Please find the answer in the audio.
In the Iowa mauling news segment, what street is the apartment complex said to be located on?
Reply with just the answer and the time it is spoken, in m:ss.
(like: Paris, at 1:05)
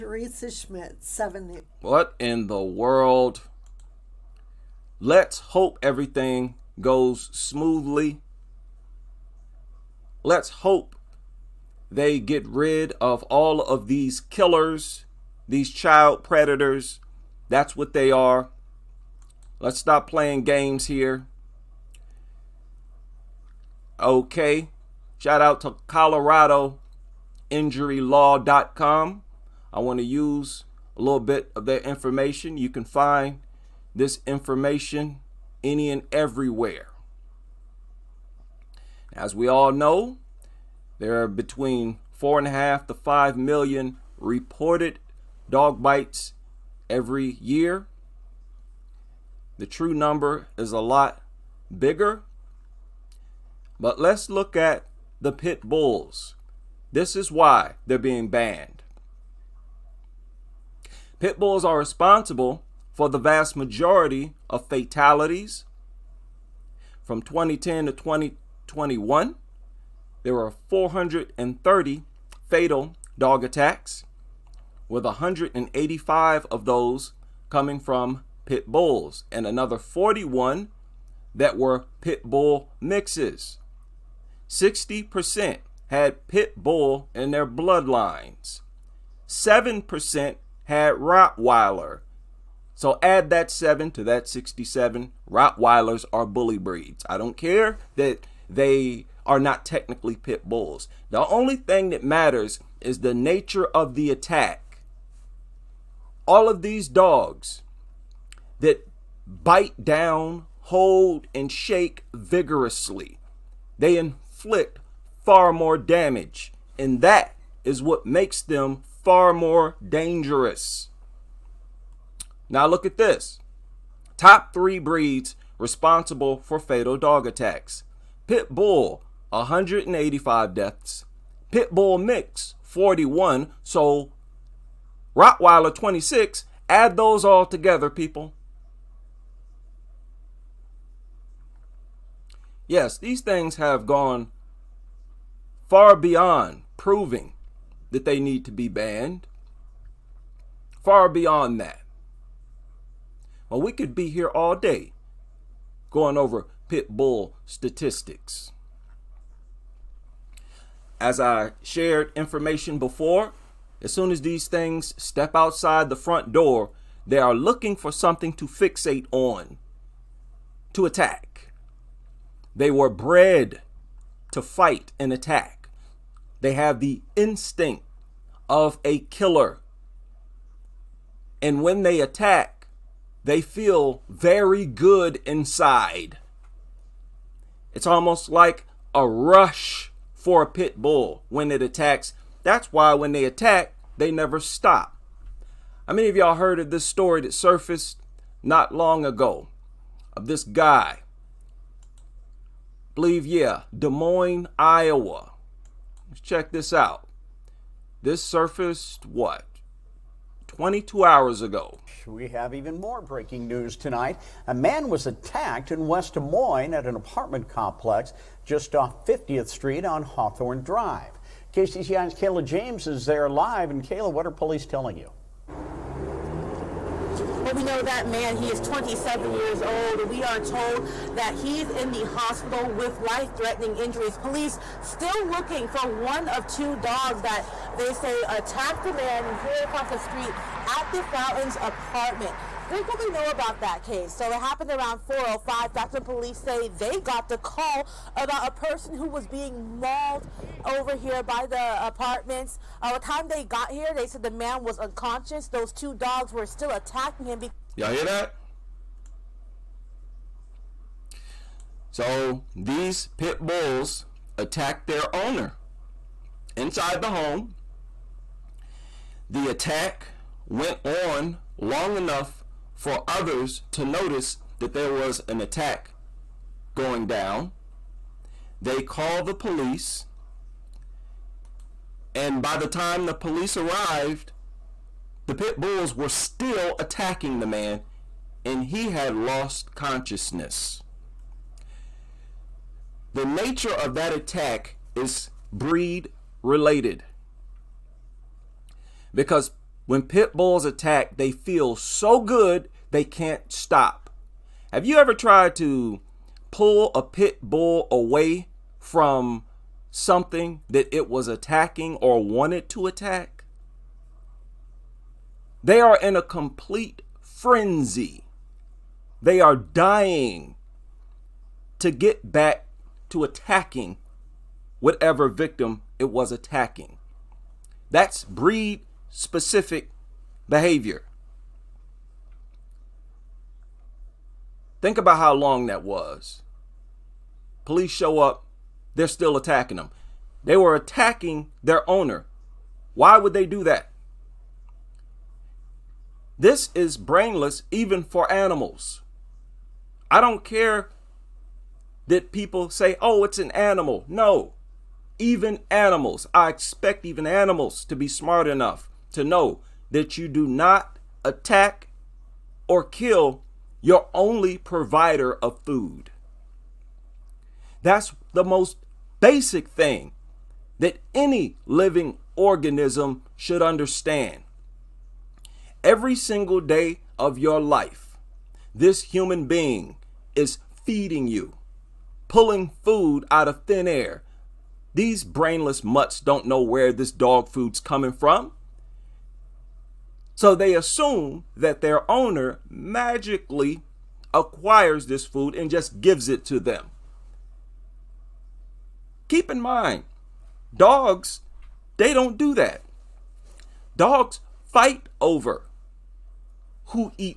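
Hawthorne Drive, at 3:40.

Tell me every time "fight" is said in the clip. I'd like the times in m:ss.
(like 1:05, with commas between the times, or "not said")
2:54, 6:44.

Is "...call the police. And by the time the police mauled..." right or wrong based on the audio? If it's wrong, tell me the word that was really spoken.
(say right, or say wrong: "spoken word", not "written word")
wrong: "arrived", not "mauled".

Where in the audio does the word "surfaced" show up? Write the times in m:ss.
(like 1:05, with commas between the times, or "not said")
3:17, 3:28.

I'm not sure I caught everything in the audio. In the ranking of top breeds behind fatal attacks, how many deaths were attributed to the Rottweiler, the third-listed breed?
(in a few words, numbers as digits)
26.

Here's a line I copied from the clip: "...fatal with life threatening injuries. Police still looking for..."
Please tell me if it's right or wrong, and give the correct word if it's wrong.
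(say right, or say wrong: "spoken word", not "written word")
wrong: "hospital", not "fatal".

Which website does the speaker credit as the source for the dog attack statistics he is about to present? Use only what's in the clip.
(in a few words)
ColoradoInjuryLaw.com.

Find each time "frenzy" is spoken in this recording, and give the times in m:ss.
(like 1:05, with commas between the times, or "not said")
5:17.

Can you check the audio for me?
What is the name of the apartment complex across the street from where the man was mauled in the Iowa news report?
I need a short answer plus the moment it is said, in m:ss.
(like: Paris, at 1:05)
the Fountains, at 4:00.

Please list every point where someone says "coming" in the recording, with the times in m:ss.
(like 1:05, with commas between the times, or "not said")
1:17, 6:27.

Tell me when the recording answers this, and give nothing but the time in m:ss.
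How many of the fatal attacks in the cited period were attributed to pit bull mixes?
1:19.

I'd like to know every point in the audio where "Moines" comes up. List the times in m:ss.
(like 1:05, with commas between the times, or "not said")
3:23, 3:36.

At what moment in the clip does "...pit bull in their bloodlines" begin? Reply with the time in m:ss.
1:26.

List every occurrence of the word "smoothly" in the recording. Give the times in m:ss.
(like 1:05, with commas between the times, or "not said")
0:07.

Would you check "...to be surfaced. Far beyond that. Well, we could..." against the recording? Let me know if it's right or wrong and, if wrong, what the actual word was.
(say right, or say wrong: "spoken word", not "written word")
wrong: "banned", not "surfaced".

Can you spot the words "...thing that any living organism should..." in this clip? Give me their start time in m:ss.
6:09.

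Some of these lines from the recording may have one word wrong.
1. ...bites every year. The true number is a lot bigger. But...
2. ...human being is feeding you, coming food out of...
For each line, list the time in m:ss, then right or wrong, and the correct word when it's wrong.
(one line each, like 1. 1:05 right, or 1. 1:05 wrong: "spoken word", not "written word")
1. 0:45 right
2. 6:19 wrong: "pulling", not "coming".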